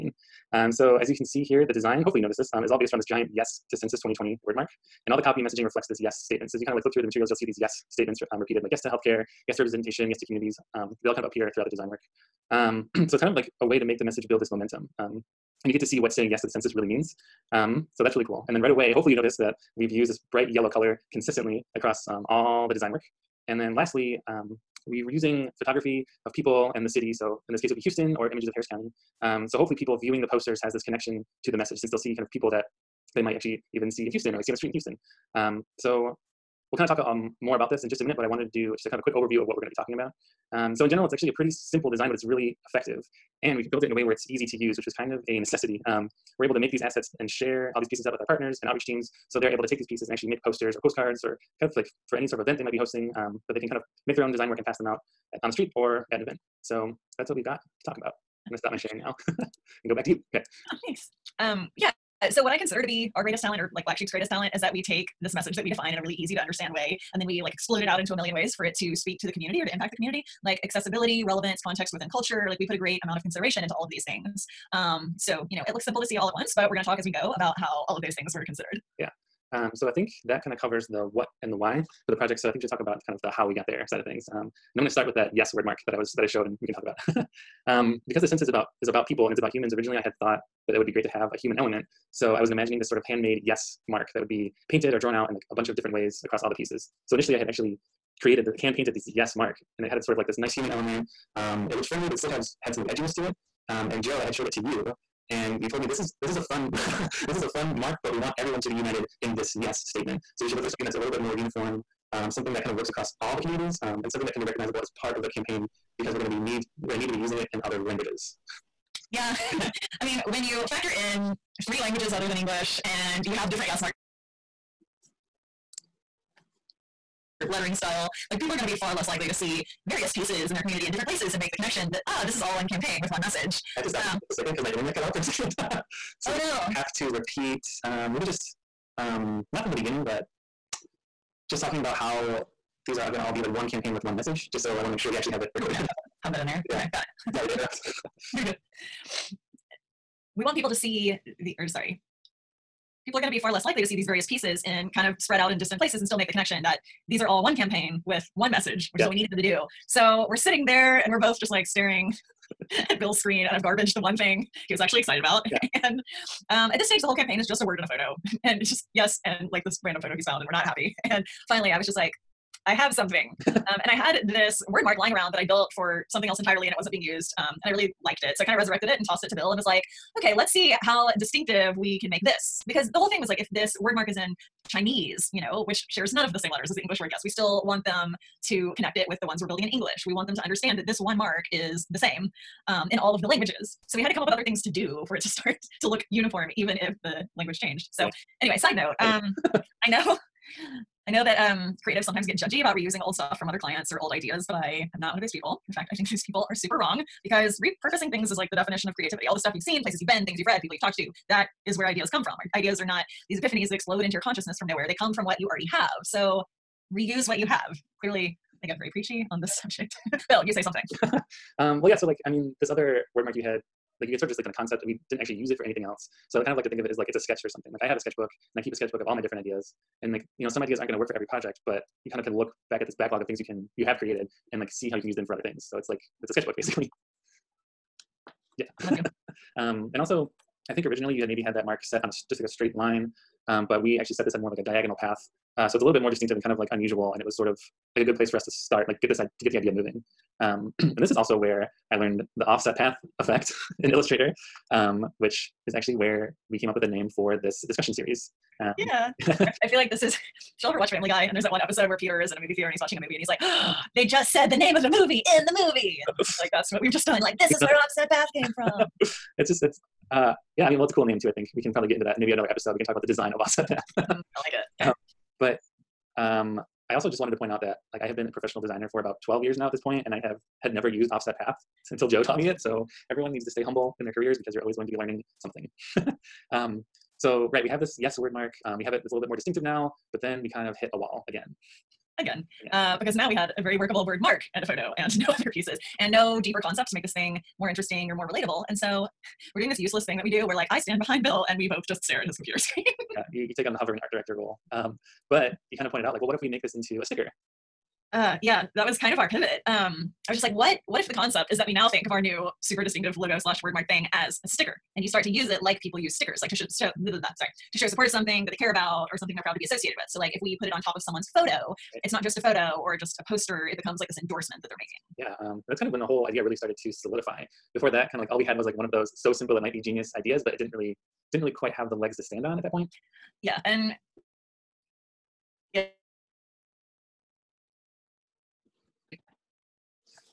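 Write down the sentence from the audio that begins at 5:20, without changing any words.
So like if we put it on top of someone's photo, right.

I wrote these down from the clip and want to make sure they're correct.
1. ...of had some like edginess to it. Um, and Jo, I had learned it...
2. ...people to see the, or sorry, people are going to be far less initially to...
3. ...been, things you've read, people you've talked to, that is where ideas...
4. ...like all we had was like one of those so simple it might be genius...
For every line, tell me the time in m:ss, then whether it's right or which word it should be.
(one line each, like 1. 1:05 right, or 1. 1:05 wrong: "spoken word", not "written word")
1. 1:42 wrong: "showed", not "learned"
2. 2:30 wrong: "likely", not "initially"
3. 3:30 right
4. 5:28 right.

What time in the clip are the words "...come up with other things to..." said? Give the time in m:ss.
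3:14.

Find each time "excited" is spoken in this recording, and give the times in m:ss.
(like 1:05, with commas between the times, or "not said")
2:44.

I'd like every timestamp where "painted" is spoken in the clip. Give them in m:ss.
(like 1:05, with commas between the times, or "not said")
1:34, 1:38.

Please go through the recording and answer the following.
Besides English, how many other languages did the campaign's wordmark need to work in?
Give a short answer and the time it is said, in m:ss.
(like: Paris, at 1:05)
three, at 2:01.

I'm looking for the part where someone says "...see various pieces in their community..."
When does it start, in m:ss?
2:09.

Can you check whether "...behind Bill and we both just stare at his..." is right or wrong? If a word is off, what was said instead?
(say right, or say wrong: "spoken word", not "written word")
right.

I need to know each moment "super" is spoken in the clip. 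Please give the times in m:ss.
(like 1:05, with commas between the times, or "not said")
3:26, 5:12.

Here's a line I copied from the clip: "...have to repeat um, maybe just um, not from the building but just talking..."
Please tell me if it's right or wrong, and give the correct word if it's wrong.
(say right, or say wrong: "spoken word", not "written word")
wrong: "beginning", not "building".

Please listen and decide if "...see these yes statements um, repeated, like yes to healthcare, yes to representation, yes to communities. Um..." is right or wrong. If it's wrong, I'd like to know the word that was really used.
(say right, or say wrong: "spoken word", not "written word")
right.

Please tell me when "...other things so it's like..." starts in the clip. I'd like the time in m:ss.
3:55.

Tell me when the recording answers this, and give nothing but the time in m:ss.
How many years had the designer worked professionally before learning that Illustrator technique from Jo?
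4:39.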